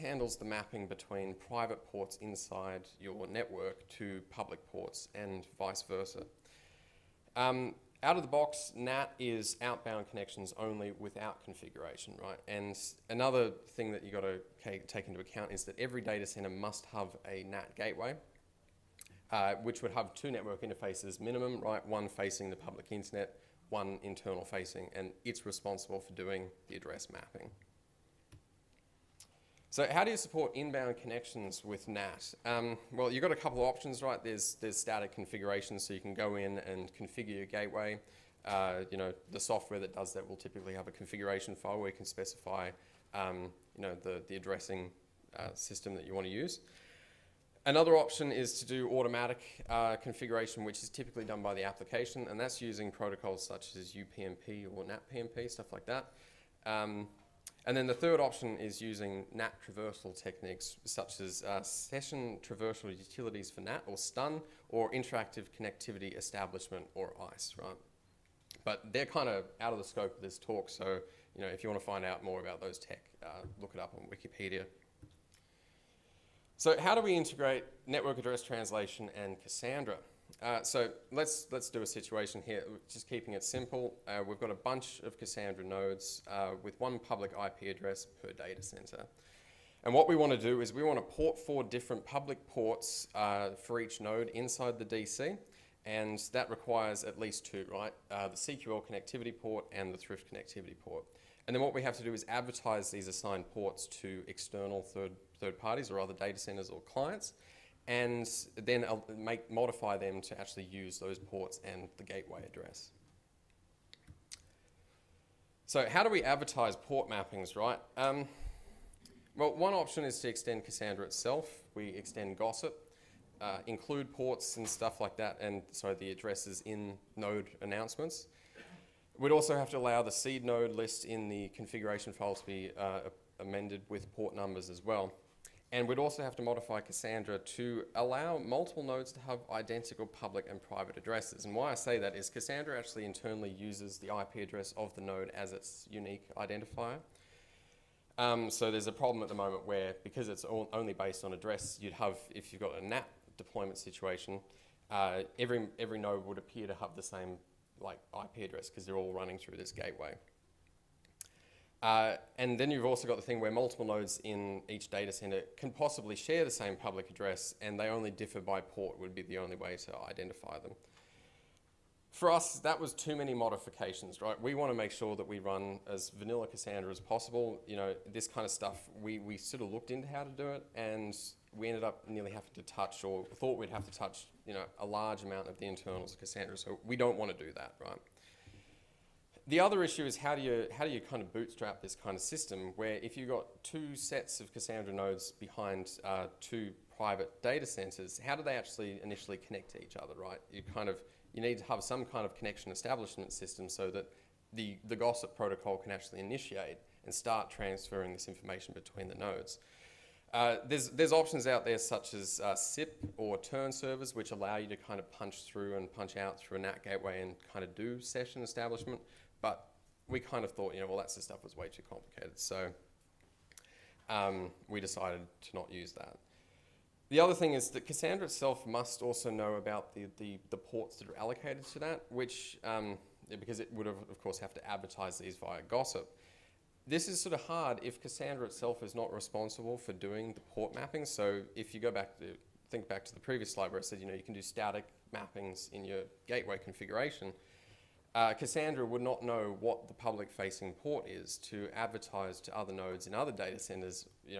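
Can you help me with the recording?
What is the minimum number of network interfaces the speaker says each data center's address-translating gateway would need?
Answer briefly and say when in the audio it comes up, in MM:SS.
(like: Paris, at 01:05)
2, at 00:20.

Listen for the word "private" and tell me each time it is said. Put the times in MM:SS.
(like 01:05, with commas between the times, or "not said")
00:01, 02:20, 03:16.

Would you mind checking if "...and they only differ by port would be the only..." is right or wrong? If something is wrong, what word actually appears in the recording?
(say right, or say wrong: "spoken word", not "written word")
right.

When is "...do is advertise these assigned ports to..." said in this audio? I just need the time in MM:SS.
01:42.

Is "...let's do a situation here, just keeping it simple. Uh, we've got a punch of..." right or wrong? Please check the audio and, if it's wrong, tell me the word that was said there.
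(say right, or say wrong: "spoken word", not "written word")
wrong: "bunch", not "punch".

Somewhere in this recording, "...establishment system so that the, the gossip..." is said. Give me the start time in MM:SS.
03:22.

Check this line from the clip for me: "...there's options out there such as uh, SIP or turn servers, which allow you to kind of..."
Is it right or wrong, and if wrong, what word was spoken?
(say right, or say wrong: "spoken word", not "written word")
right.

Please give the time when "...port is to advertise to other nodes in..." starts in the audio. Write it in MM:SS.
04:10.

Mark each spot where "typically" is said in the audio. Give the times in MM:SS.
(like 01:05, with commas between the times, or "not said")
00:40, 00:50.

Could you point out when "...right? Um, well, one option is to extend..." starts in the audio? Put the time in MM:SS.
01:57.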